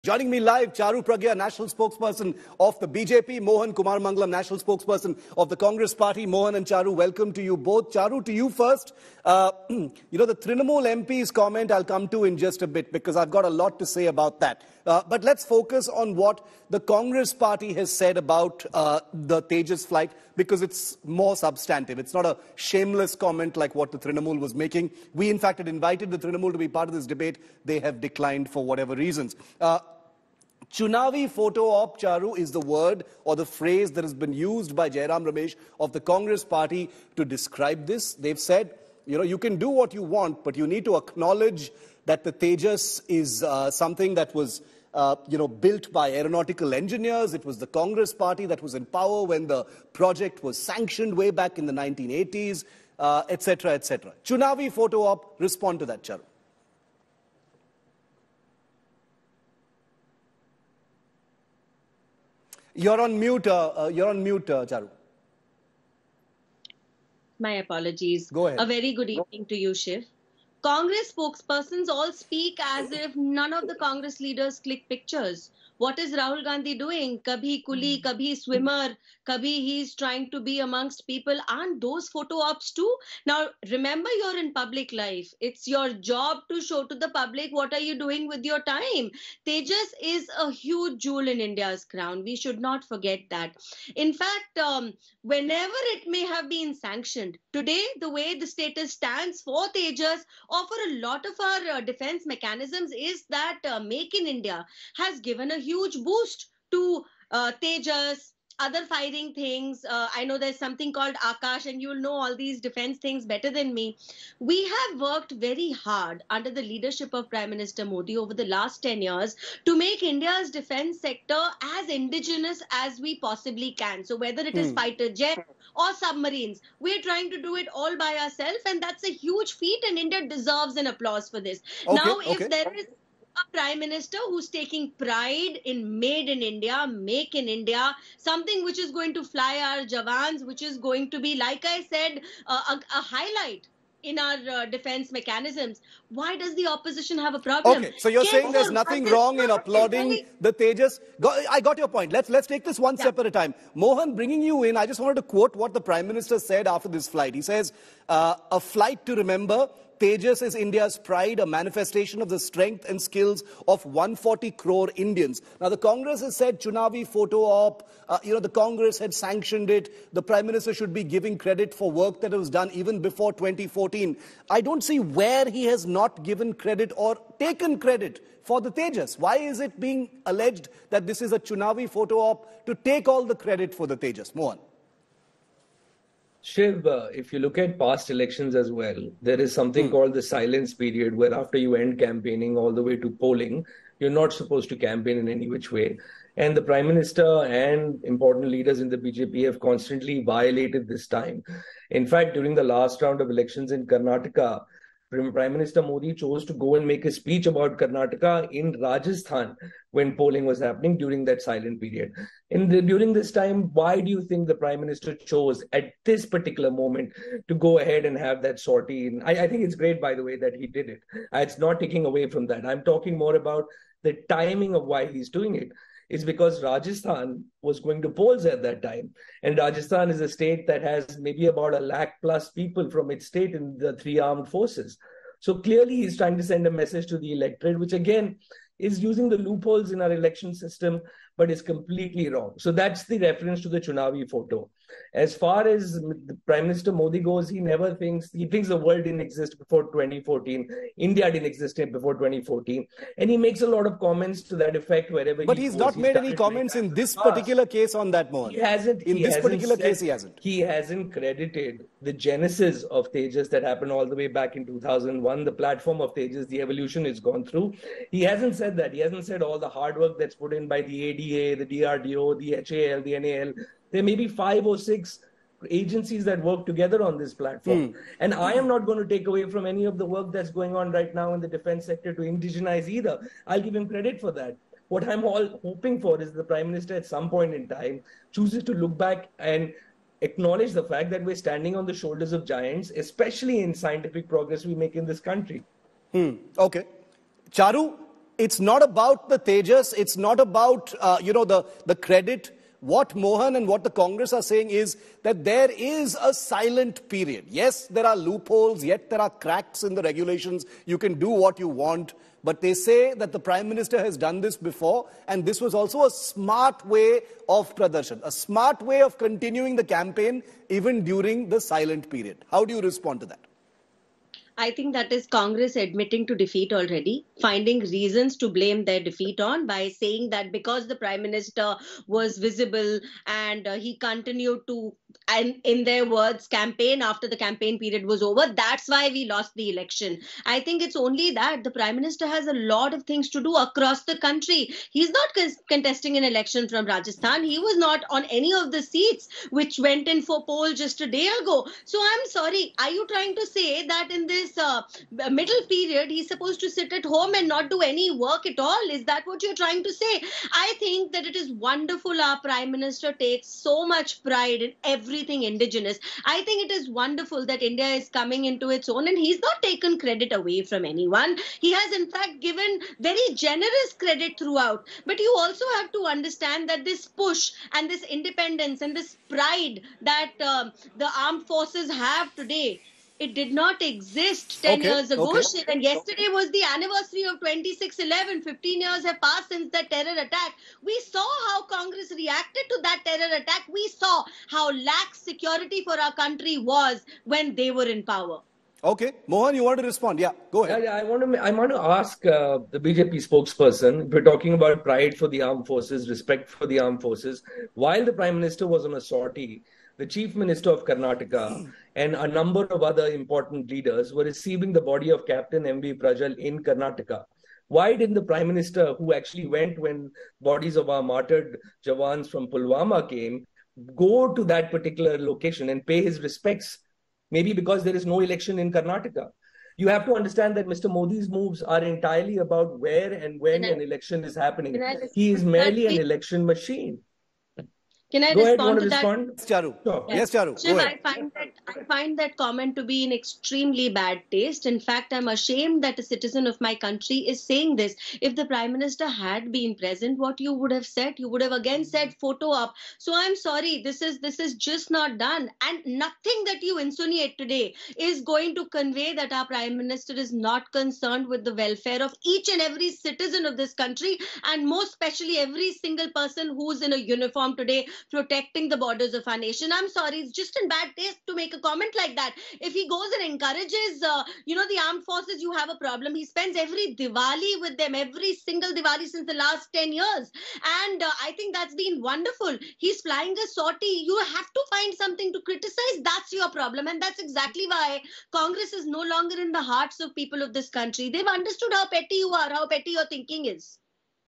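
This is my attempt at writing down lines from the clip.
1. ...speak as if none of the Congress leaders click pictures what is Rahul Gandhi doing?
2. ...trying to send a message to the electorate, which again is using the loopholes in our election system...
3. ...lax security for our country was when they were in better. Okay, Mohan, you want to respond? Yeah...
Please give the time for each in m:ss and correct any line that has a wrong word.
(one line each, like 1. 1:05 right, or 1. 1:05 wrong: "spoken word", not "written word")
1. 1:12 right
2. 3:56 right
3. 6:34 wrong: "power", not "better".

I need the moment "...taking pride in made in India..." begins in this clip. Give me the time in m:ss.
2:14.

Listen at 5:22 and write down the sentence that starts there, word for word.
How do you respond to that?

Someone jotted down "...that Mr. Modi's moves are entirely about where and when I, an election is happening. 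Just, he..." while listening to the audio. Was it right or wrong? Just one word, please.
right.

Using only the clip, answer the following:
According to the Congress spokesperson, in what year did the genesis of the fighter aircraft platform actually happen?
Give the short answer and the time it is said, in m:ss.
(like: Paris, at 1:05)
2001, at 4:24.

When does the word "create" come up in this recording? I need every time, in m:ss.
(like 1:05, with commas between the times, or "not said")
not said.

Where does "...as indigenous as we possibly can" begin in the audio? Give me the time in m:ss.
2:01.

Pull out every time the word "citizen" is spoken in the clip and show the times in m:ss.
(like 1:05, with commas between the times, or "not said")
7:26, 7:42.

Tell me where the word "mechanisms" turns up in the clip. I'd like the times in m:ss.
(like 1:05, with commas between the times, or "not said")
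1:42, 2:25.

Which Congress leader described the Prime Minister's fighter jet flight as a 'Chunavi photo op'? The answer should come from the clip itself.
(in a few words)
Jairam Ramesh.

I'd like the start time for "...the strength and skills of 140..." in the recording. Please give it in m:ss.
2:42.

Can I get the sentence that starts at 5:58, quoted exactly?
Is that what you're trying to say?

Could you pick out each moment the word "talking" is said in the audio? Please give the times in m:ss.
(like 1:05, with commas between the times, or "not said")
3:42, 6:44.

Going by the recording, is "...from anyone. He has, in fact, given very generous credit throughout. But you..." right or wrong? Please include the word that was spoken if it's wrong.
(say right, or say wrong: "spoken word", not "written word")
right.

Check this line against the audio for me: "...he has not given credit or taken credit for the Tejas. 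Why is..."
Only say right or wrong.
right.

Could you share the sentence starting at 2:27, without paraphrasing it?
Okay, so you're Can saying there's nothing wrong in applauding the Tejas.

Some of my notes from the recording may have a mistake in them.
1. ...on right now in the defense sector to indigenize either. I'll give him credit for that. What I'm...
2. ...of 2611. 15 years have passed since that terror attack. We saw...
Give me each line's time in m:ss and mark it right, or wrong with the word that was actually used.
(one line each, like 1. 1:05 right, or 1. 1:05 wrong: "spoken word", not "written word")
1. 4:40 right
2. 6:27 right.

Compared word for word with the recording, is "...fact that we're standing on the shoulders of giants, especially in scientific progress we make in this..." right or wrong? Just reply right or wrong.
right.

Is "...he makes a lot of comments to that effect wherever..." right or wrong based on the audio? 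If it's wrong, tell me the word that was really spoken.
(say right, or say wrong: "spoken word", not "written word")
right.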